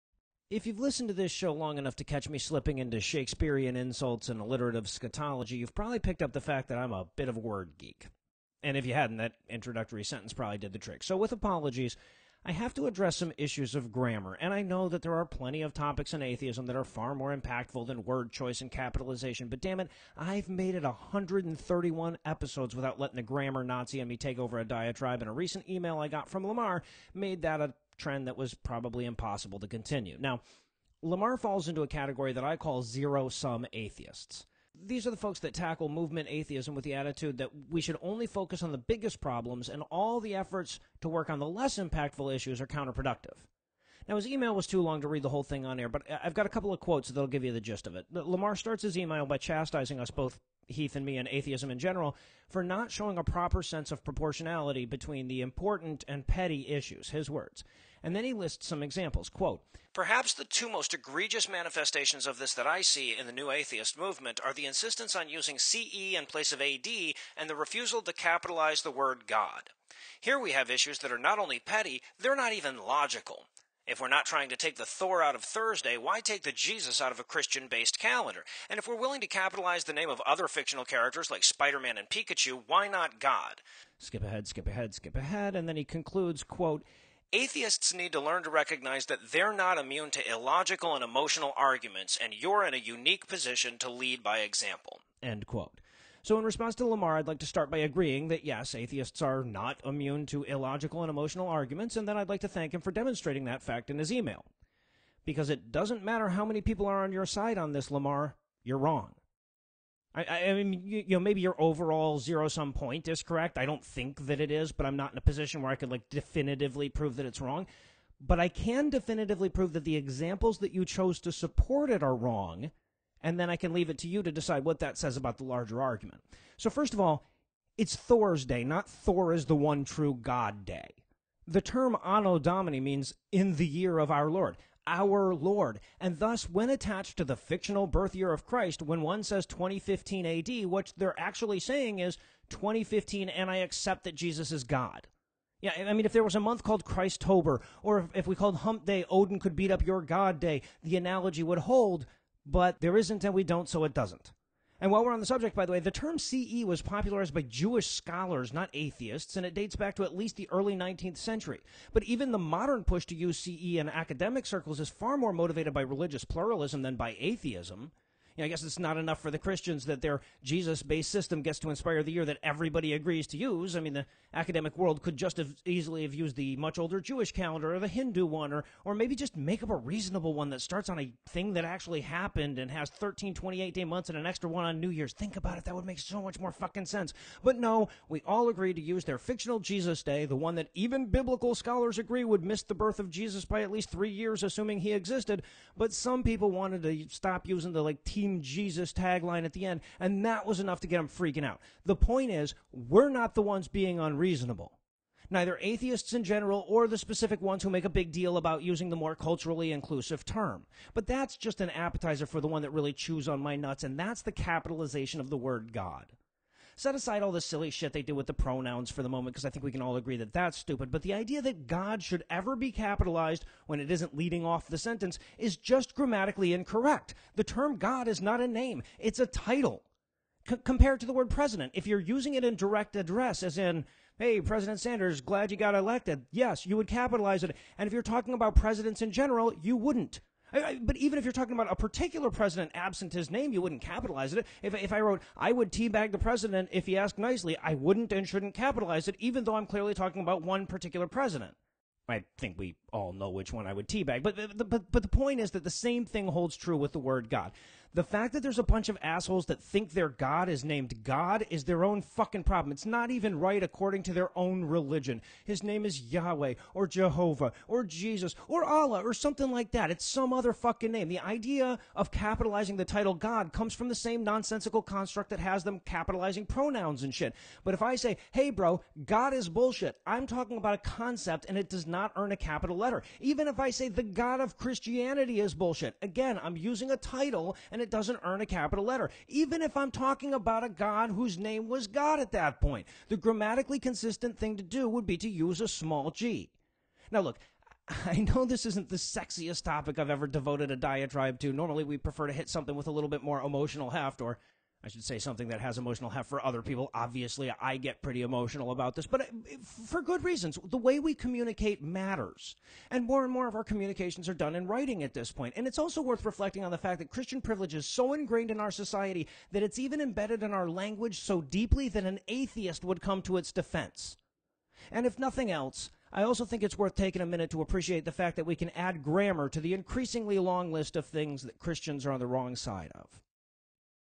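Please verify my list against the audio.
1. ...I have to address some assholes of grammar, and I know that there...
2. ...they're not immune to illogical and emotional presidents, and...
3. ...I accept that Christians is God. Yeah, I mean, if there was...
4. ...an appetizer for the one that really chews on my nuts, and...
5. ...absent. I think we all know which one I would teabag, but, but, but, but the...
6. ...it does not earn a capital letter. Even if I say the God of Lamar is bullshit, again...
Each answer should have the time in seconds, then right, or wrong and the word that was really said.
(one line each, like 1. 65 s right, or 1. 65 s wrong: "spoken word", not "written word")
1. 12 s wrong: "issues", not "assholes"
2. 89 s wrong: "arguments", not "presidents"
3. 143 s wrong: "Jesus", not "Christians"
4. 211 s right
5. 251 s wrong: "president", not "absent"
6. 281 s wrong: "Christianity", not "Lamar".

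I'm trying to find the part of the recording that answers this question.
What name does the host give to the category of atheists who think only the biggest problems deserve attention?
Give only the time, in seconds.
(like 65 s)
32 s.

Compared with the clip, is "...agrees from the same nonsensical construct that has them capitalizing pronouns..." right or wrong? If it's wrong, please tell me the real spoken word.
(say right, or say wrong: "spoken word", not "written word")
wrong: "comes", not "agrees".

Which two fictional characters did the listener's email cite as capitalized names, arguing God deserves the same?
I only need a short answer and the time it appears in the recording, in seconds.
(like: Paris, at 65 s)
Spider Man and Pikachu, at 81 s.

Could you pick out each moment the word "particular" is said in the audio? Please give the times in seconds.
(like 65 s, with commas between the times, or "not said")
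241 s, 250 s.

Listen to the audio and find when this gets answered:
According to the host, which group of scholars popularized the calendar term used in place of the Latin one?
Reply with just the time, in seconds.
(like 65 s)
157 s.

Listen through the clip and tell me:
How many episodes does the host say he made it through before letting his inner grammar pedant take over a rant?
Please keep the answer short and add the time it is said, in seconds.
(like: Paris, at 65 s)
131, at 20 s.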